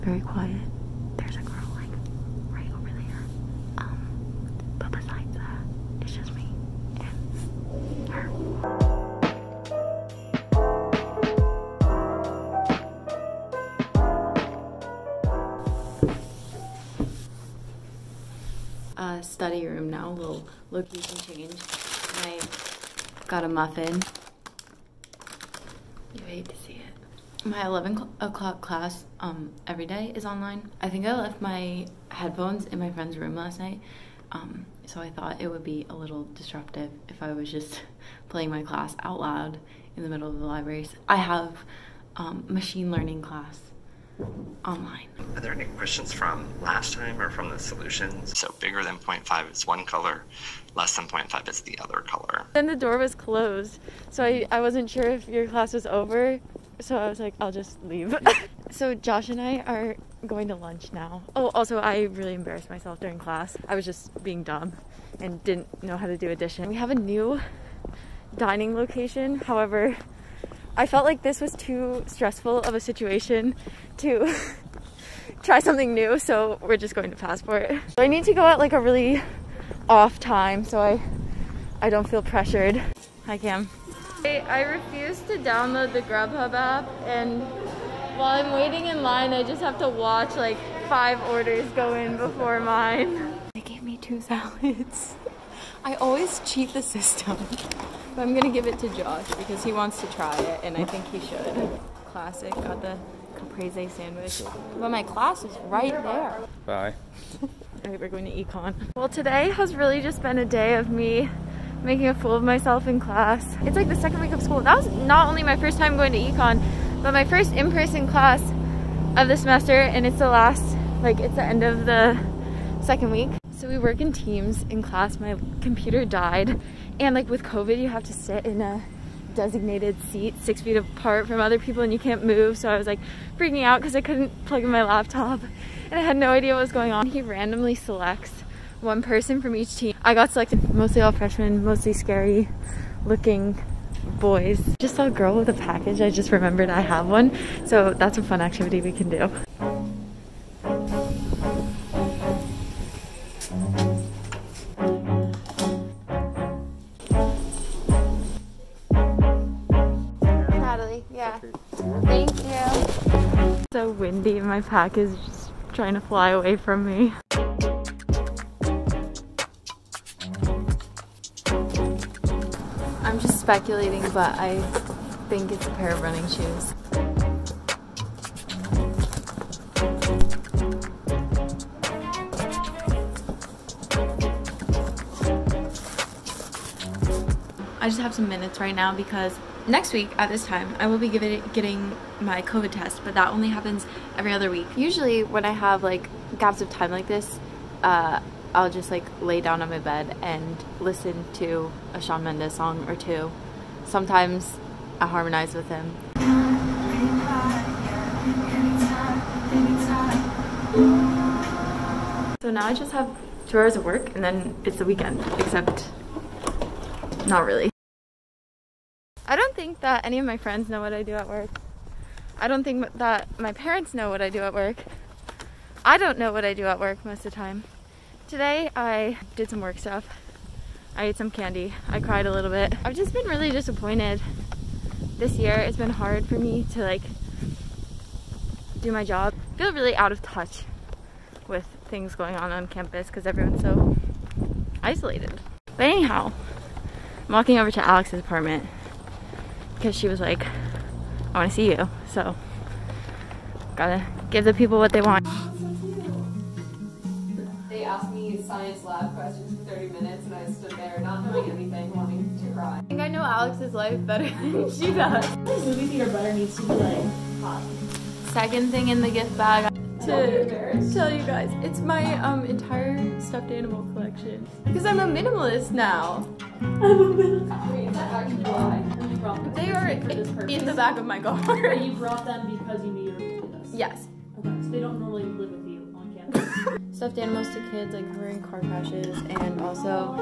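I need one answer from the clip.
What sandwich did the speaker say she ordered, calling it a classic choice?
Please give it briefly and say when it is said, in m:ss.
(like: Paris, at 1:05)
Caprese sandwich, at 1:43.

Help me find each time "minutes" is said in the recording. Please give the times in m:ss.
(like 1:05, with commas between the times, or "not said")
3:08, 4:19.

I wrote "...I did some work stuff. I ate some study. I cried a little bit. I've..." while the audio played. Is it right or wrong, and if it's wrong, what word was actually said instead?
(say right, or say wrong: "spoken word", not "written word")
wrong: "candy", not "study".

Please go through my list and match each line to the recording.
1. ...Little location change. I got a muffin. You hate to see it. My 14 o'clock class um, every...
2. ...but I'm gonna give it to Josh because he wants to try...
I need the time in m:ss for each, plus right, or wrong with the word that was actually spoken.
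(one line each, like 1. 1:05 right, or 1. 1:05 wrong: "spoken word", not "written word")
1. 0:20 wrong: "11", not "14"
2. 1:38 right.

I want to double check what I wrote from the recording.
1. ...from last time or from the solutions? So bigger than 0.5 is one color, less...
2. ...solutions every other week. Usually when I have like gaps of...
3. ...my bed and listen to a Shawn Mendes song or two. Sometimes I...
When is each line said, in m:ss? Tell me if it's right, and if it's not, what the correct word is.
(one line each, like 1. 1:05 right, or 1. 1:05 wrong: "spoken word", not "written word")
1. 0:46 right
2. 3:13 wrong: "happens", not "solutions"
3. 3:19 right.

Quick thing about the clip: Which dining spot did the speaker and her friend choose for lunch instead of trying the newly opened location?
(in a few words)
Passport.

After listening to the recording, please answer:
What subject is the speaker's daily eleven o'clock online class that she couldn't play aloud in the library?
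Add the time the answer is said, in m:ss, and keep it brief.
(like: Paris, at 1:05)
Machine learning, at 0:42.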